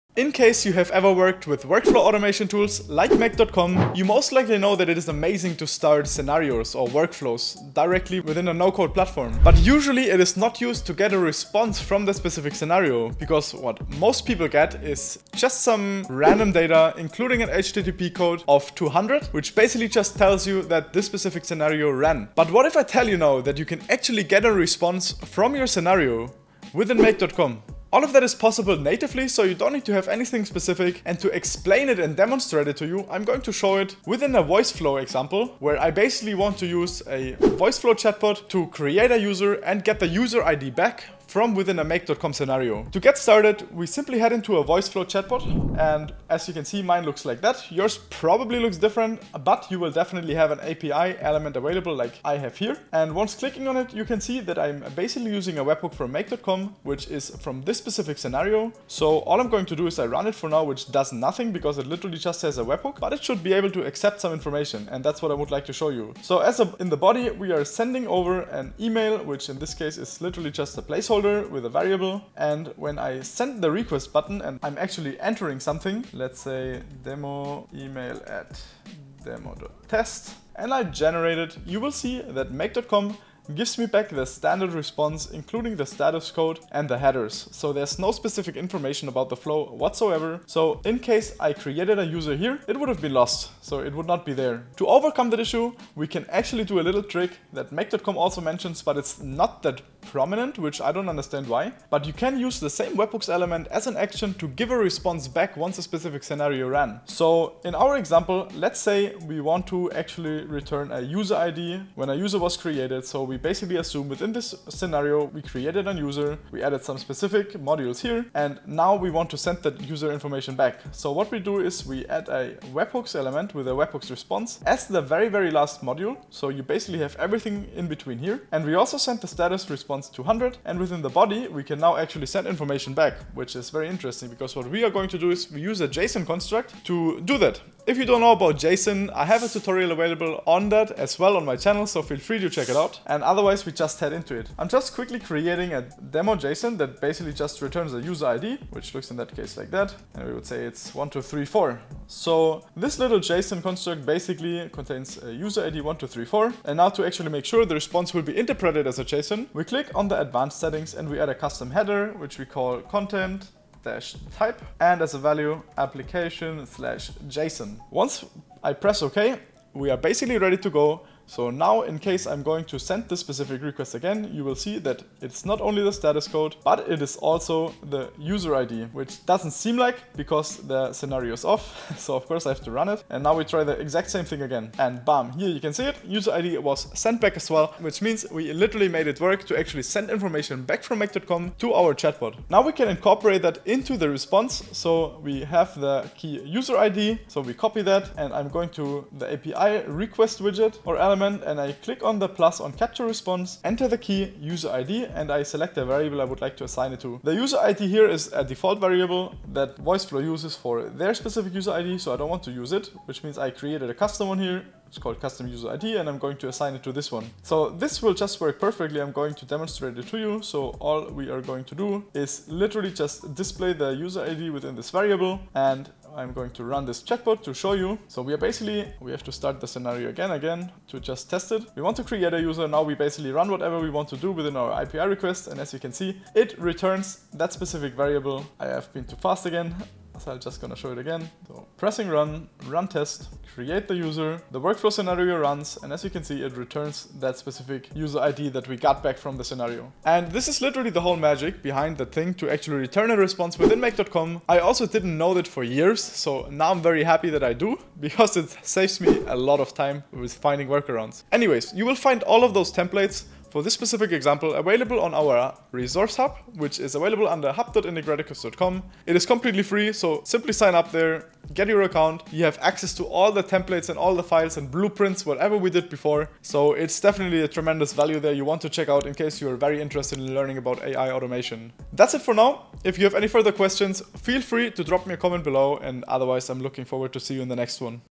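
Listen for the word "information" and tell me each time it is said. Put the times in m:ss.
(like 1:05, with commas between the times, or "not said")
1:04, 1:28, 2:00, 2:12, 3:10.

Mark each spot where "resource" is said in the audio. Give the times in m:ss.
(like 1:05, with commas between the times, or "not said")
4:25.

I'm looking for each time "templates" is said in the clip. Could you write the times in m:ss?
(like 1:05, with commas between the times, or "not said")
4:22, 4:33.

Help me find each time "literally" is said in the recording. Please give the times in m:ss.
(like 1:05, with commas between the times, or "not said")
1:01, 1:10, 3:08, 3:42, 4:10.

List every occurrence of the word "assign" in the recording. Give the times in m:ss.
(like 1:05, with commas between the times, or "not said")
3:26, 3:36.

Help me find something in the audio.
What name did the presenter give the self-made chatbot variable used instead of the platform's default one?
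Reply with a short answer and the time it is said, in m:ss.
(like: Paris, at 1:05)
custom user ID, at 3:35.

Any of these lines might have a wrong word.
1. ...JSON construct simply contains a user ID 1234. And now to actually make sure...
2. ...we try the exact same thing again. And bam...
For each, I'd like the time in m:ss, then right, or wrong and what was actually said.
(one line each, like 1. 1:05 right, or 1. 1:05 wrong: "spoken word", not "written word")
1. 2:33 wrong: "basically", not "simply"
2. 3:03 right.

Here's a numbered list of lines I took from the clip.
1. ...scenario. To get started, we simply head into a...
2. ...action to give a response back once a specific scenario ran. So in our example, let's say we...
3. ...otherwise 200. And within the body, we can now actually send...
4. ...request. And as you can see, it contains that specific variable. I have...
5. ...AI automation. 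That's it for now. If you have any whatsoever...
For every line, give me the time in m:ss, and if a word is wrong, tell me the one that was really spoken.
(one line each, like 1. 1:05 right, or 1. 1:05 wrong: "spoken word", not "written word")
1. 0:42 right
2. 1:43 right
3. 2:09 wrong: "response", not "otherwise"
4. 3:55 wrong: "returns", not "contains"
5. 4:40 wrong: "further", not "whatsoever".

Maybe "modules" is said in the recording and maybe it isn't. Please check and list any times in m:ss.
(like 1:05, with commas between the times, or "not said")
1:57, 2:05.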